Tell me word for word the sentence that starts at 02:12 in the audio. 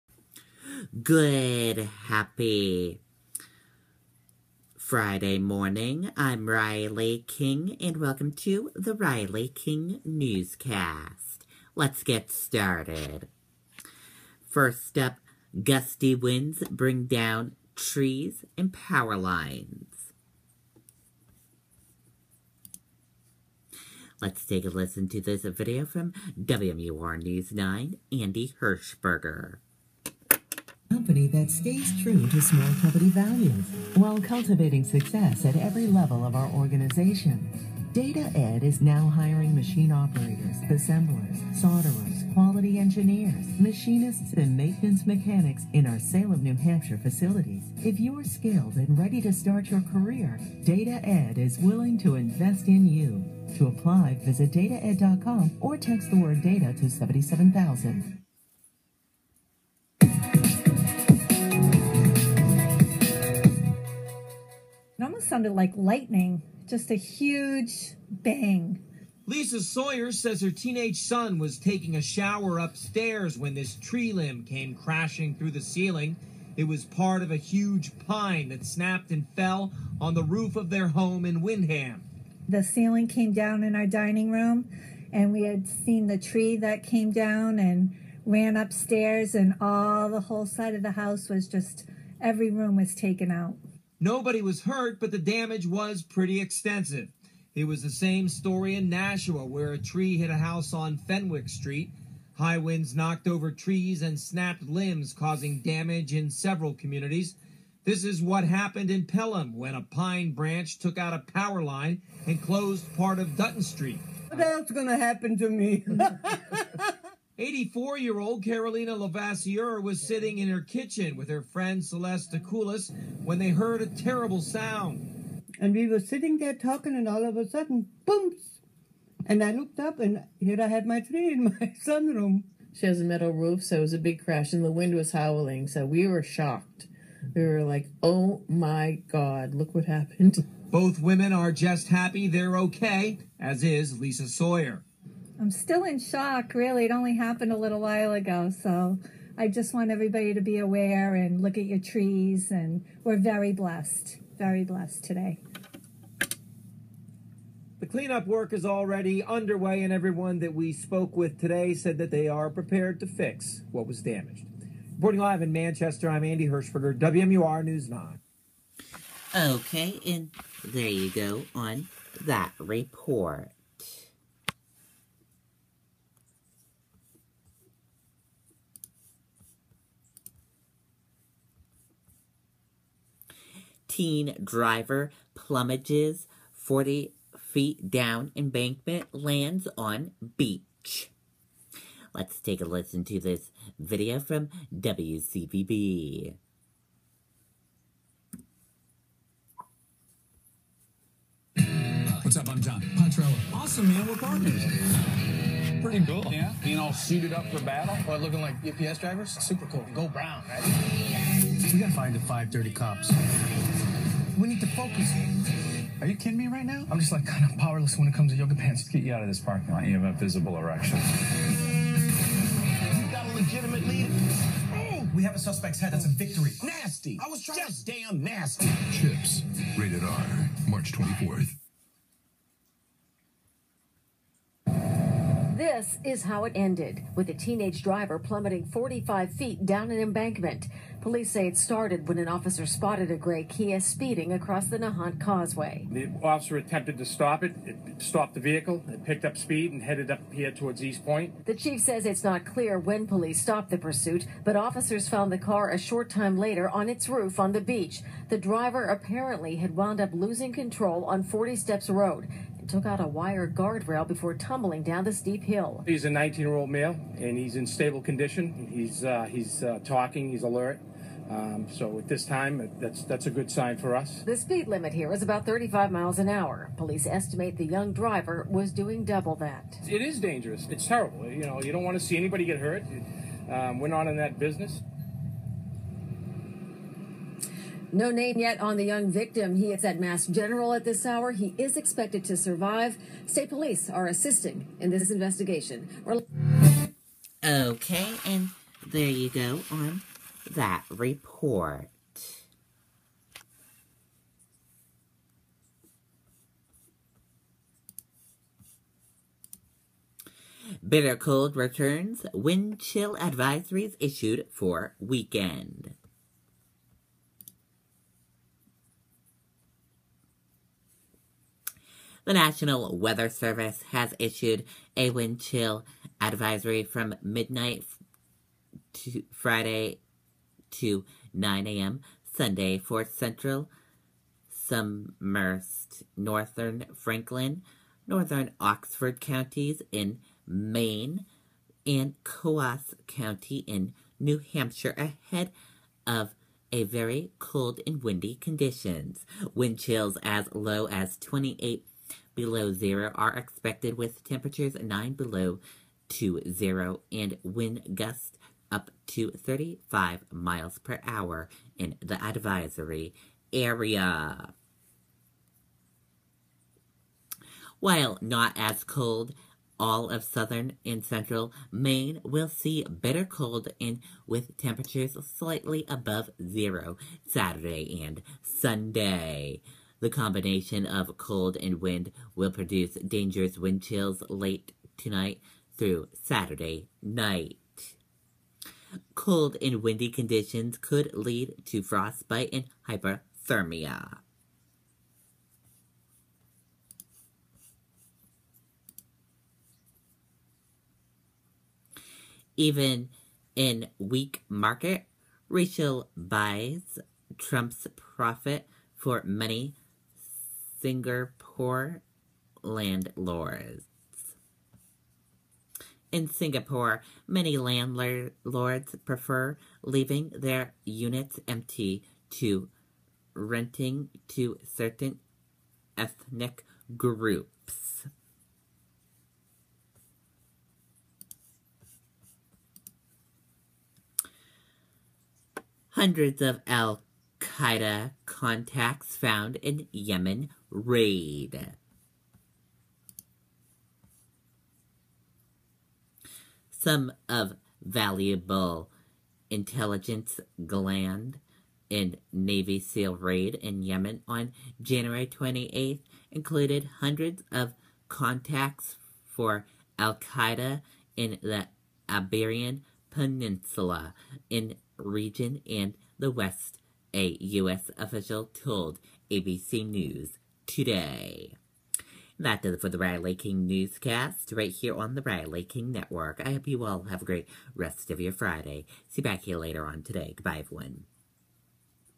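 She has a metal roof, so it was a big crash, and the wind was howling, so we were shocked.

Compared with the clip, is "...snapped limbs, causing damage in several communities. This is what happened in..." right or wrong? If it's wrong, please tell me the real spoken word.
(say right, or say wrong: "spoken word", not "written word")
right.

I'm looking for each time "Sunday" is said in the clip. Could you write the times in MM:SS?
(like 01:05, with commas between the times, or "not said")
05:32, 06:18.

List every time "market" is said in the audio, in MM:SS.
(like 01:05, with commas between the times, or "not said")
06:44.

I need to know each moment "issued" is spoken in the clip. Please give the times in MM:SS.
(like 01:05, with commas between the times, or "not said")
05:13, 05:24.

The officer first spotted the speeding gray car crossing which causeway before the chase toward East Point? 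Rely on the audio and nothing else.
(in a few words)
Nahant Causeway.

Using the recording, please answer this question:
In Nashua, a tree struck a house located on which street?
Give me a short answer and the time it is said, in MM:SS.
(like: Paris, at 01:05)
Fenwick Street, at 01:40.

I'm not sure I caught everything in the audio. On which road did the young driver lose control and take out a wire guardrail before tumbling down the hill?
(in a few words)
40 Steps Road.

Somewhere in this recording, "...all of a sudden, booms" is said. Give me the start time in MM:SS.
02:07.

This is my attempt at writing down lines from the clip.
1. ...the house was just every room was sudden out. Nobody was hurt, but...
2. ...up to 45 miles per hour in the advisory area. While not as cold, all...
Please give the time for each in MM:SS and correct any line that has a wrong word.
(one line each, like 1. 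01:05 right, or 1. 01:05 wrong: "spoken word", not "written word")
1. 01:30 wrong: "taken", not "sudden"
2. 05:58 wrong: "35", not "45".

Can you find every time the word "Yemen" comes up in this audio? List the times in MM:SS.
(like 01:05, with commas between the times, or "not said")
07:19, 07:33.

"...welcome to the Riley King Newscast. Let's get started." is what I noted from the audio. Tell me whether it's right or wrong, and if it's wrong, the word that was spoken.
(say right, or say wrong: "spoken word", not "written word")
right.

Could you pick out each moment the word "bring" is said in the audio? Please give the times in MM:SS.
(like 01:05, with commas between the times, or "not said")
00:16.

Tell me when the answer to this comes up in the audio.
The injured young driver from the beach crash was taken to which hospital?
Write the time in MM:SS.
04:49.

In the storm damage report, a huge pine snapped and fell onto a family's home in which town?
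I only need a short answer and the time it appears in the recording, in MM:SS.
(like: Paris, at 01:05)
Windham, at 01:21.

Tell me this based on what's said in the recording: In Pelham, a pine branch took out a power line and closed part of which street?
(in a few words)
Dutton Street.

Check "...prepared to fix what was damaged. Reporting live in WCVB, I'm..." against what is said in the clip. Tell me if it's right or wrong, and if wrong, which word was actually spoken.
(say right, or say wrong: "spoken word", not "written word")
wrong: "Manchester", not "WCVB".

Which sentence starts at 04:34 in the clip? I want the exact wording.
The speed limit here is about 35 miles an hour.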